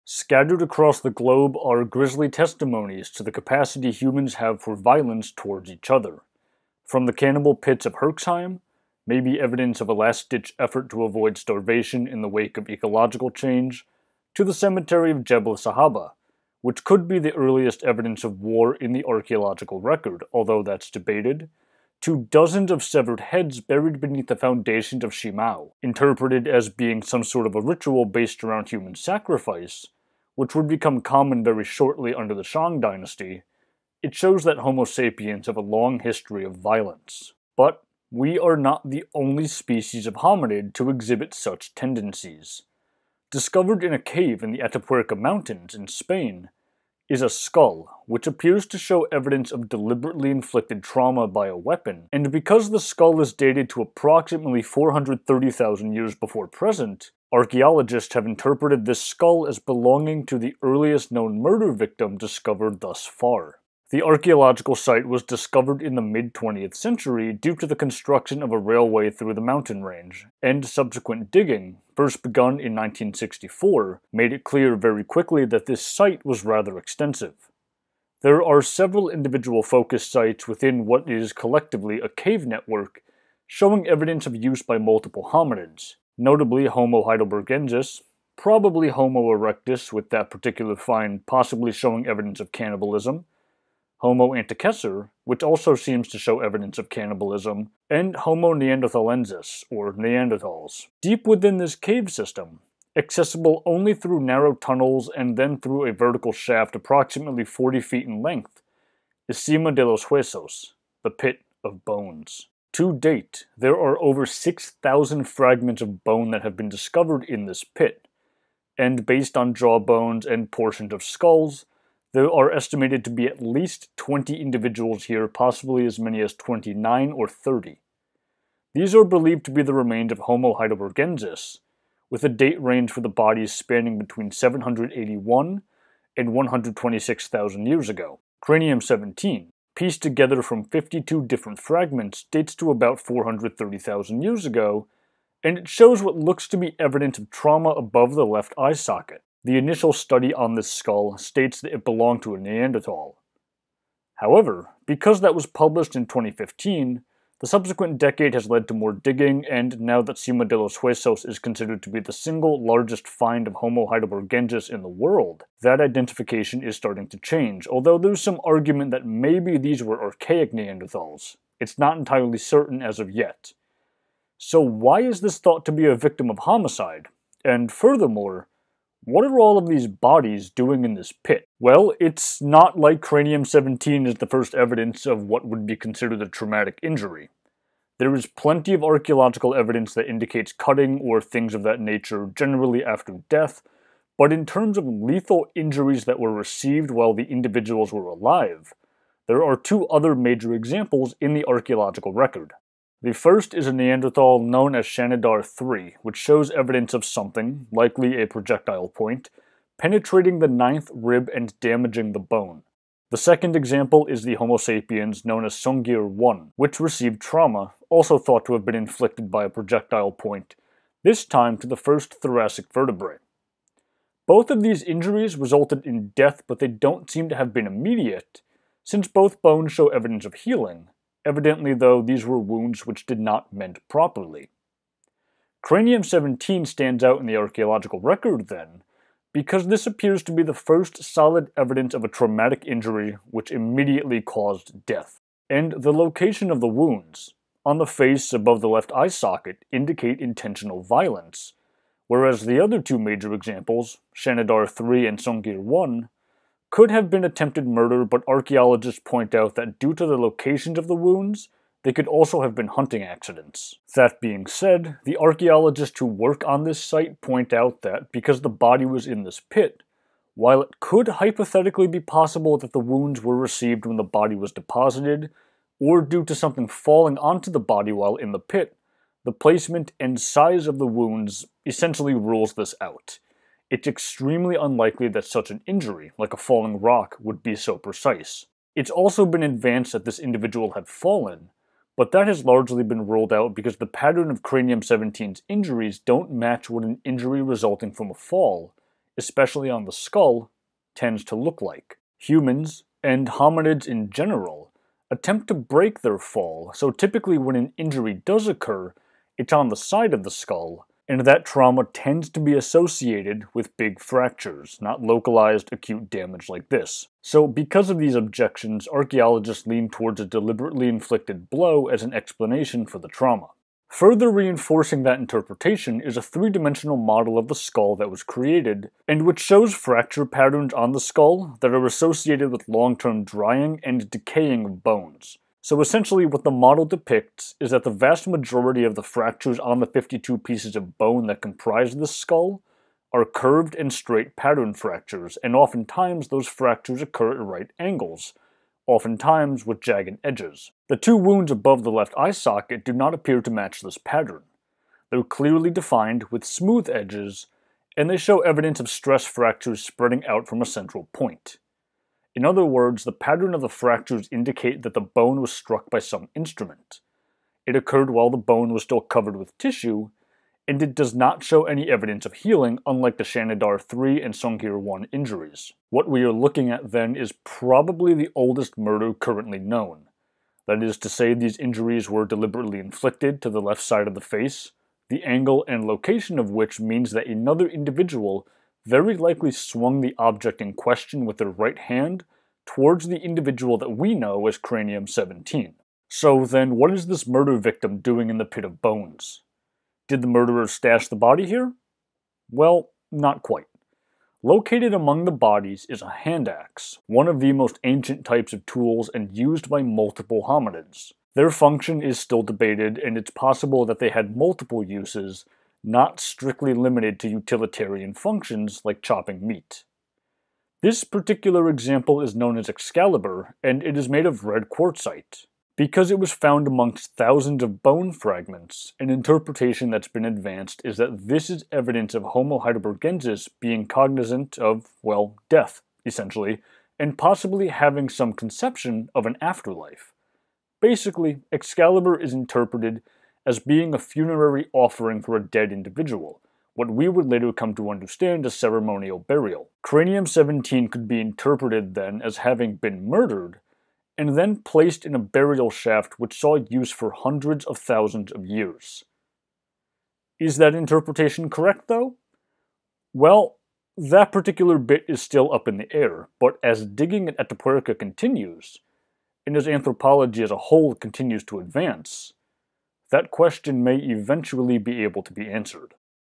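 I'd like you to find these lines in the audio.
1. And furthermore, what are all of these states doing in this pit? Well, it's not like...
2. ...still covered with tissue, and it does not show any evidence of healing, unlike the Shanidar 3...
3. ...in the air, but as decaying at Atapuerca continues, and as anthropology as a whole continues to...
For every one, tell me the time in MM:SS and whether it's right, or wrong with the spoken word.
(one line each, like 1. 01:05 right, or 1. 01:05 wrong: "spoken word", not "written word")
1. 02:57 wrong: "bodies", not "states"
2. 06:08 right
3. 07:45 wrong: "digging", not "decaying".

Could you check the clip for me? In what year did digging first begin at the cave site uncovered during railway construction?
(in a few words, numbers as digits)
1964.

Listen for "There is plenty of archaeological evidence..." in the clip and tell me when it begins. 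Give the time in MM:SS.
03:07.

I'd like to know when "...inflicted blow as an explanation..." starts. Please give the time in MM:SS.
05:20.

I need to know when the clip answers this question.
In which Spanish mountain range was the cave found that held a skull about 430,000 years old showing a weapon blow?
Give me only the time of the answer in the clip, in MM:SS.
00:44.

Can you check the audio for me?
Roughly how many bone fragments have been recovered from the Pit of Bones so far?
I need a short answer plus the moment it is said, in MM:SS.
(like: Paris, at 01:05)
6,000, at 01:54.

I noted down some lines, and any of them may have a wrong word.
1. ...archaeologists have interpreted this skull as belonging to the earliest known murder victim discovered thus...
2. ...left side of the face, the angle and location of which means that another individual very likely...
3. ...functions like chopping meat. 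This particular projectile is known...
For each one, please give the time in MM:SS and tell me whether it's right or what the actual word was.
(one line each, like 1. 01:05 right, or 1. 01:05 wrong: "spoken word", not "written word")
1. 00:57 right
2. 06:23 right
3. 06:58 wrong: "example", not "projectile".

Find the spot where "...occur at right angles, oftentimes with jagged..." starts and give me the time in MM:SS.
05:47.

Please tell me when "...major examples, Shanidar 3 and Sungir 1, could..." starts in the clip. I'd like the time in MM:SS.
04:12.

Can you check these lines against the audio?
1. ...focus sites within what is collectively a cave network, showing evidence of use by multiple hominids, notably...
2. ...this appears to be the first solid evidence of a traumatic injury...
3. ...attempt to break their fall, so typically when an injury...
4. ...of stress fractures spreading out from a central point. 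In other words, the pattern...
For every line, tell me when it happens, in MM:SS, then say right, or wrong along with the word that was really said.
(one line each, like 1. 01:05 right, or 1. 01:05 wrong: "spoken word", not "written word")
1. 01:19 right
2. 03:59 right
3. 05:05 right
4. 05:58 right.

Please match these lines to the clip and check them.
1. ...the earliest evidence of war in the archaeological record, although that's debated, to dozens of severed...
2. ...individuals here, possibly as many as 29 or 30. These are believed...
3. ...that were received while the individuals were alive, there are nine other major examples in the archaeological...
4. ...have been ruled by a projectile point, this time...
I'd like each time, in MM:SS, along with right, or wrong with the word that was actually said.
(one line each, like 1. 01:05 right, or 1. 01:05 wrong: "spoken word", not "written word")
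1. 00:17 right
2. 02:04 right
3. 03:16 wrong: "two", not "nine"
4. 03:38 wrong: "inflicted", not "ruled".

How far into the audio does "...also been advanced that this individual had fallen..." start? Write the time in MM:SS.
04:48.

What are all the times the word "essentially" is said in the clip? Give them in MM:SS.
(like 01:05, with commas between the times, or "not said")
04:41, 05:35, 07:16.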